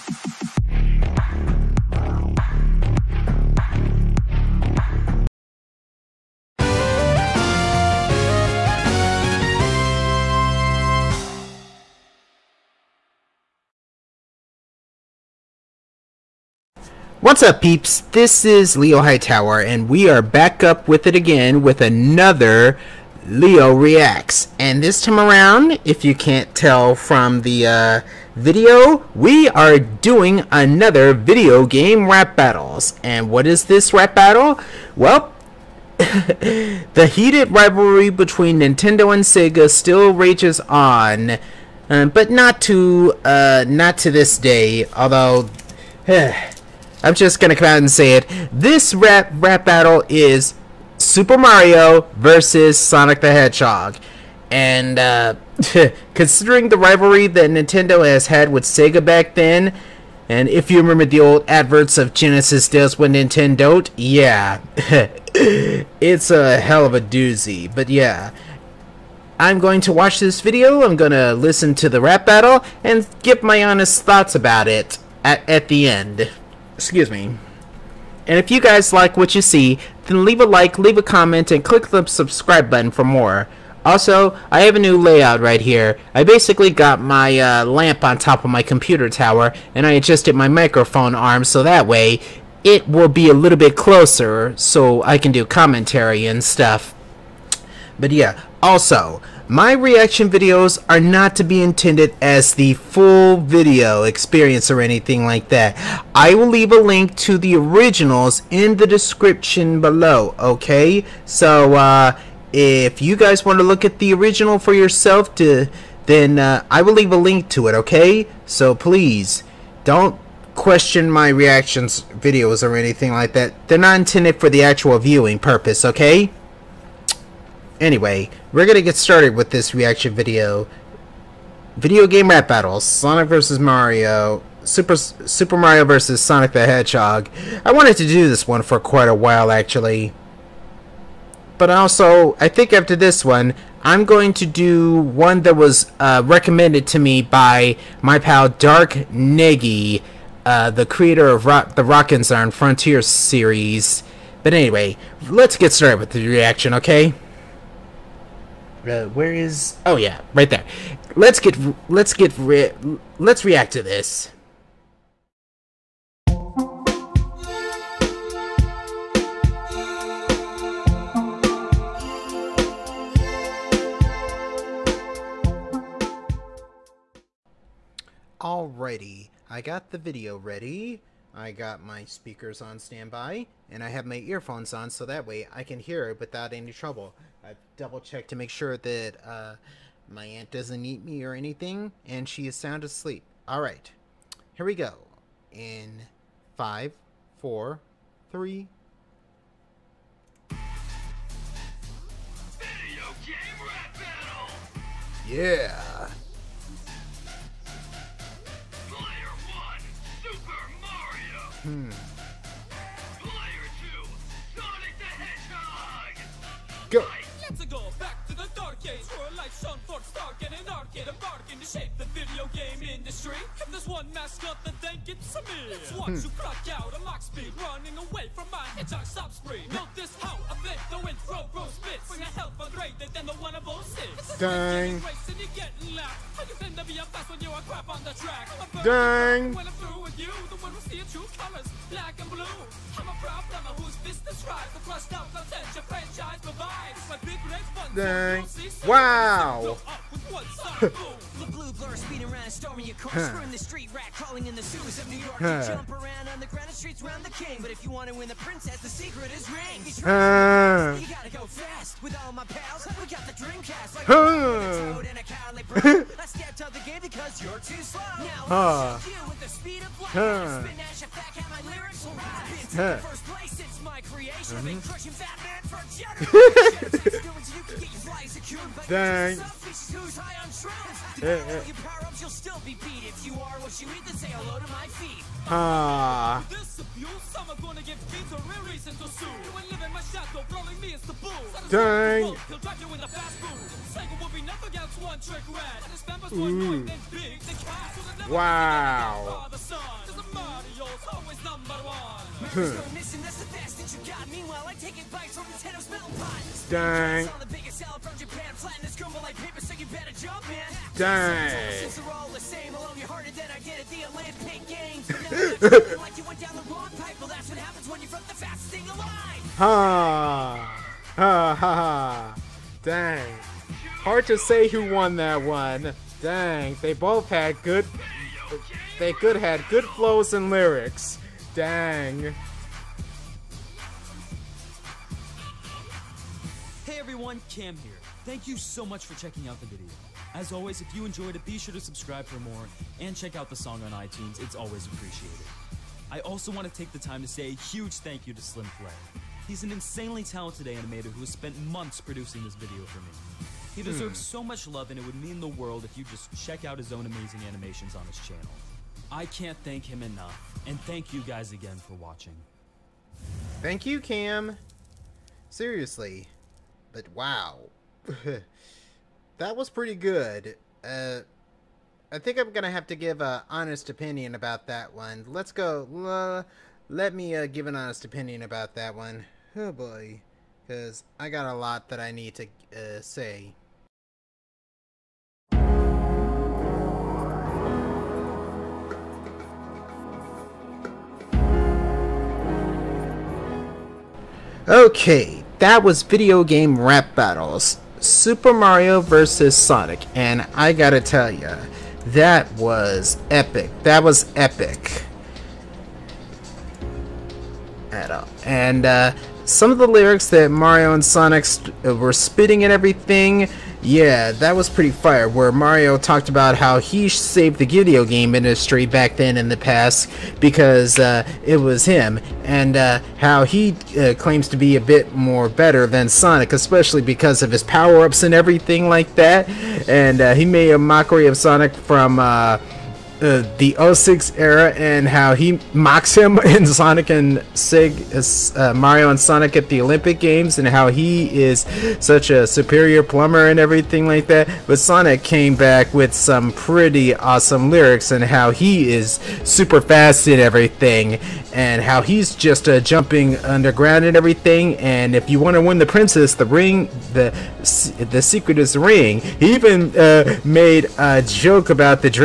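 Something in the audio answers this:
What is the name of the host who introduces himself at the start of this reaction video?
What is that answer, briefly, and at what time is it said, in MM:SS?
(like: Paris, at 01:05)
Leo Hightower, at 00:18.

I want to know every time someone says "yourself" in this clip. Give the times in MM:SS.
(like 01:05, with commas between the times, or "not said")
01:54.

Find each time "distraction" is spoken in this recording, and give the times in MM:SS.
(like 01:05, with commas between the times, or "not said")
not said.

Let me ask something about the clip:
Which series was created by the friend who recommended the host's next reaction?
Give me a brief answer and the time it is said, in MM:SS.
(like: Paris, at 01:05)
Rockin' Zarn Frontier, at 02:31.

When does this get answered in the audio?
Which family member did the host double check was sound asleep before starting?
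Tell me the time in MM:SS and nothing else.
03:10.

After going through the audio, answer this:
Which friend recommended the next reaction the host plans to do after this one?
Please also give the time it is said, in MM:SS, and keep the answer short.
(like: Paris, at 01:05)
Dark Negi, at 02:28.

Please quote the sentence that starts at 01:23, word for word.
Also, I have a new layout right here.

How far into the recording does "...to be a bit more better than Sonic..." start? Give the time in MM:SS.
07:04.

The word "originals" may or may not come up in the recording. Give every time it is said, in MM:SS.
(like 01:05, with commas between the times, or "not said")
01:47, 01:54.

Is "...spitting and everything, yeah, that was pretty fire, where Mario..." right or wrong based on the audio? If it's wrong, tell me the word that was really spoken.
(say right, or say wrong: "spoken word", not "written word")
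right.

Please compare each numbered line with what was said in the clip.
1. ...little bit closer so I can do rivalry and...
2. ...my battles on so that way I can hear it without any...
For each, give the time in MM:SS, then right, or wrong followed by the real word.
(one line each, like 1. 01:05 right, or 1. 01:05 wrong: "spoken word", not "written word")
1. 01:33 wrong: "commentary", not "rivalry"
2. 03:04 wrong: "earphones", not "battles".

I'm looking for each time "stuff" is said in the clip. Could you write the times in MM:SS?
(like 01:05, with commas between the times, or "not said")
01:36.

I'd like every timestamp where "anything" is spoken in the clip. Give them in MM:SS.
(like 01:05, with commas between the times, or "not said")
01:44, 02:02, 03:11.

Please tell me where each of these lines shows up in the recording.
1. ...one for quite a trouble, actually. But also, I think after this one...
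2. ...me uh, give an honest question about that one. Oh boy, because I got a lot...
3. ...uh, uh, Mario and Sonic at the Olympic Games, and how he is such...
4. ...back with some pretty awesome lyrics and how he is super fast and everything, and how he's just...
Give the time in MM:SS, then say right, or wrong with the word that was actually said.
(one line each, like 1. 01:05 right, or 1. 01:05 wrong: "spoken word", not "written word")
1. 02:18 wrong: "while", not "trouble"
2. 06:17 wrong: "opinion", not "question"
3. 07:18 right
4. 07:25 right.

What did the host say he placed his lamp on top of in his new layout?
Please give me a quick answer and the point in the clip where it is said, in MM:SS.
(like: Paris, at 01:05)
computer tower, at 01:28.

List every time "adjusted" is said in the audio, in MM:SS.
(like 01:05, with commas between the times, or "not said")
01:29.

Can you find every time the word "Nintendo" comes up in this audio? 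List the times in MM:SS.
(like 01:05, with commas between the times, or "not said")
00:38, 00:57, 01:03.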